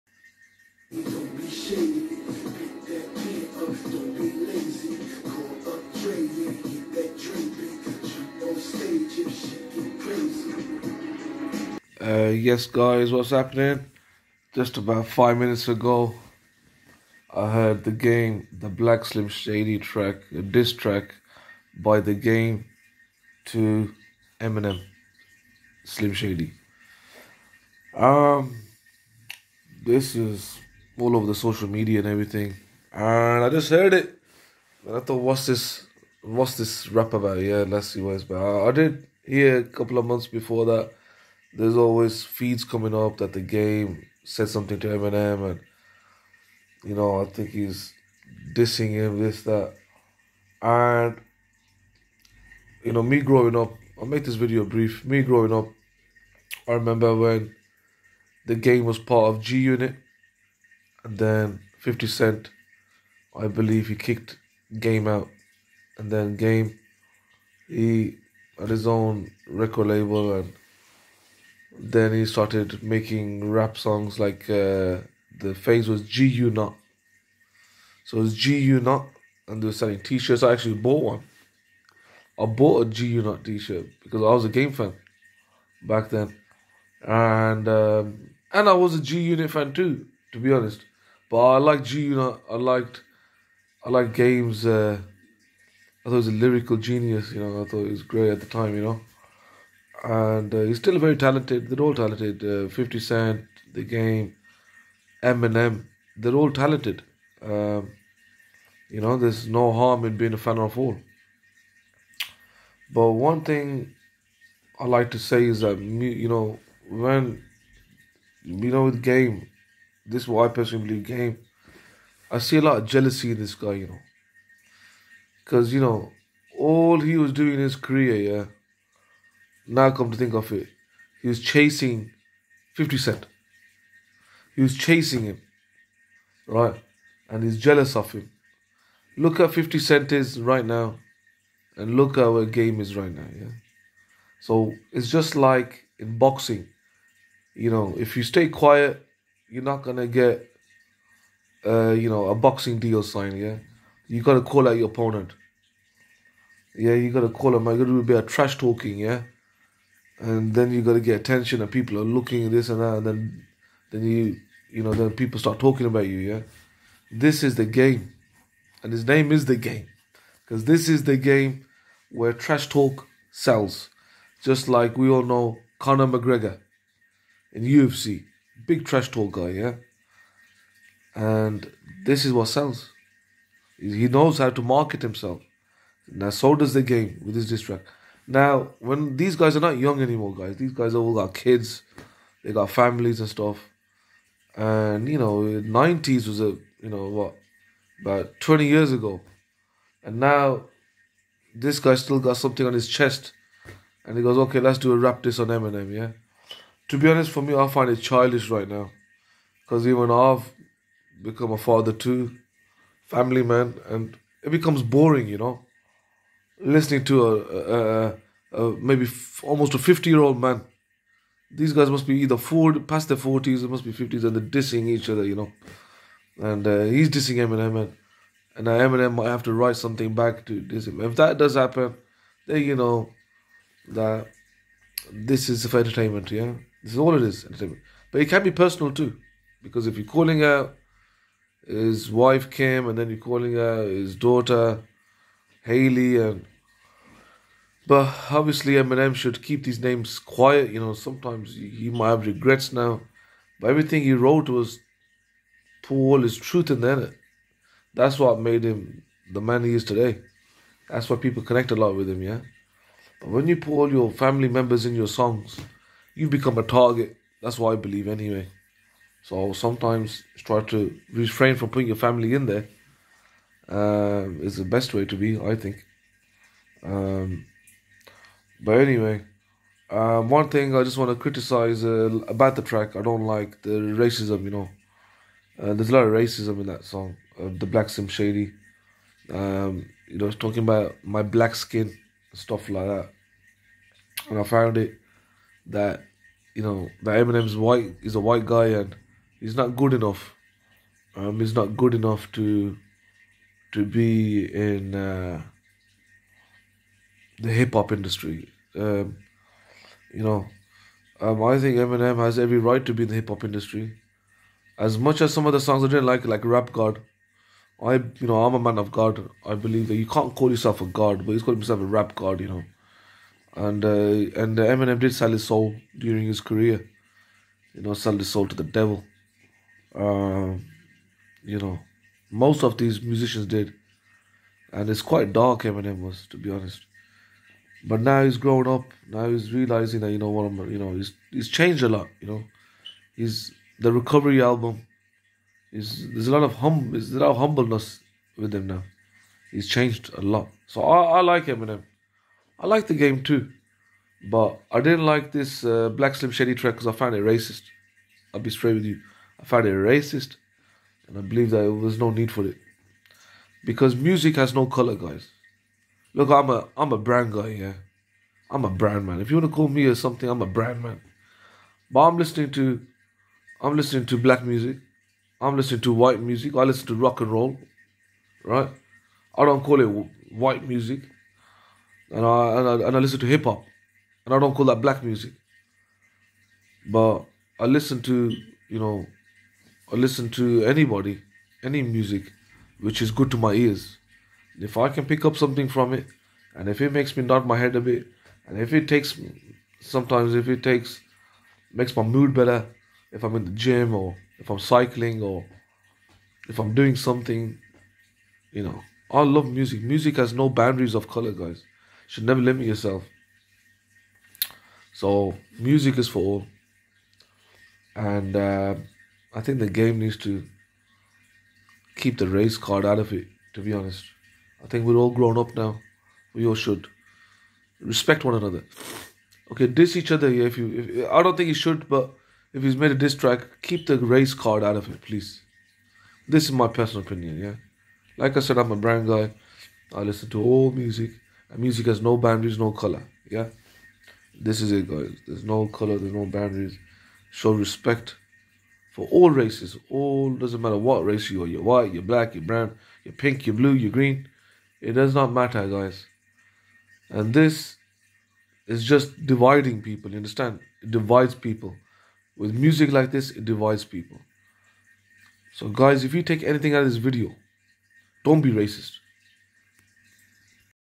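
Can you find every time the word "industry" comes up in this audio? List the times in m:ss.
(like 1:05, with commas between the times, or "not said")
5:07, 5:13.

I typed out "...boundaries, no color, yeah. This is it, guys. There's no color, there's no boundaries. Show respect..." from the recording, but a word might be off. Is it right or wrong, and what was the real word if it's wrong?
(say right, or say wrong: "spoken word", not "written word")
right.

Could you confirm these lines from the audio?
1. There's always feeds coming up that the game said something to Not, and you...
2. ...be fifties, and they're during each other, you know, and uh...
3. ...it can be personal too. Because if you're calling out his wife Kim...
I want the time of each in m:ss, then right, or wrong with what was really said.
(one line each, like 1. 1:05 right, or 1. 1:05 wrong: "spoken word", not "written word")
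1. 0:41 wrong: "Eminem", not "Not"
2. 3:43 wrong: "dissing", not "during"
3. 3:58 right.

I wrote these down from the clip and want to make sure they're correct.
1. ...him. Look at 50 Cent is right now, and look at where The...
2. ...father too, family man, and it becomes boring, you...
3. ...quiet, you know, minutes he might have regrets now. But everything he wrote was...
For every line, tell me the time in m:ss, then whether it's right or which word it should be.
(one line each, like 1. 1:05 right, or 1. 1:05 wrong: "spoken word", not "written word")
1. 2:18 wrong: "Game", not "The"
2. 3:31 right
3. 4:10 wrong: "sometimes", not "minutes".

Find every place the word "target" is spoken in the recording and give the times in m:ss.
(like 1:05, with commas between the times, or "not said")
4:26.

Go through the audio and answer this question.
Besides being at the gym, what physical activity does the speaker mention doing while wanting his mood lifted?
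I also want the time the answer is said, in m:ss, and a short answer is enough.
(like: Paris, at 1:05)
cycling, at 6:44.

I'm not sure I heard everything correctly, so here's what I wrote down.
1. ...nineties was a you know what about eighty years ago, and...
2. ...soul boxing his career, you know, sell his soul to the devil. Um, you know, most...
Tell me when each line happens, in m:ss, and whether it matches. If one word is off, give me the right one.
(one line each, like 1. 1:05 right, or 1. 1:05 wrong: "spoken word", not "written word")
1. 3:15 wrong: "twenty", not "eighty"
2. 5:25 wrong: "during", not "boxing".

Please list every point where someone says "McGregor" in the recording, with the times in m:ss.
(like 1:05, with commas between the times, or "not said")
2:56.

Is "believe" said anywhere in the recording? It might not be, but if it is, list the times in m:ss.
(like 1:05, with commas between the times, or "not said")
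1:03, 2:00, 4:27, 5:19, 6:01.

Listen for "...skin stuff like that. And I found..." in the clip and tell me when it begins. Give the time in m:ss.
4:51.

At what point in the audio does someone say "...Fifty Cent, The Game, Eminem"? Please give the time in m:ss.
1:42.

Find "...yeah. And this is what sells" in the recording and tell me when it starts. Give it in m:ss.
2:59.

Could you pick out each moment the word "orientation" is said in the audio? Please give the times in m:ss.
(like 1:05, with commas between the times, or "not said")
not said.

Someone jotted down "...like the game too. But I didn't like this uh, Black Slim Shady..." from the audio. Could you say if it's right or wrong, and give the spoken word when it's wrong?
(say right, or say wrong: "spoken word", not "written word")
right.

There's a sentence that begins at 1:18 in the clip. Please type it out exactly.
So it's was GU Not, and they were selling t shirts.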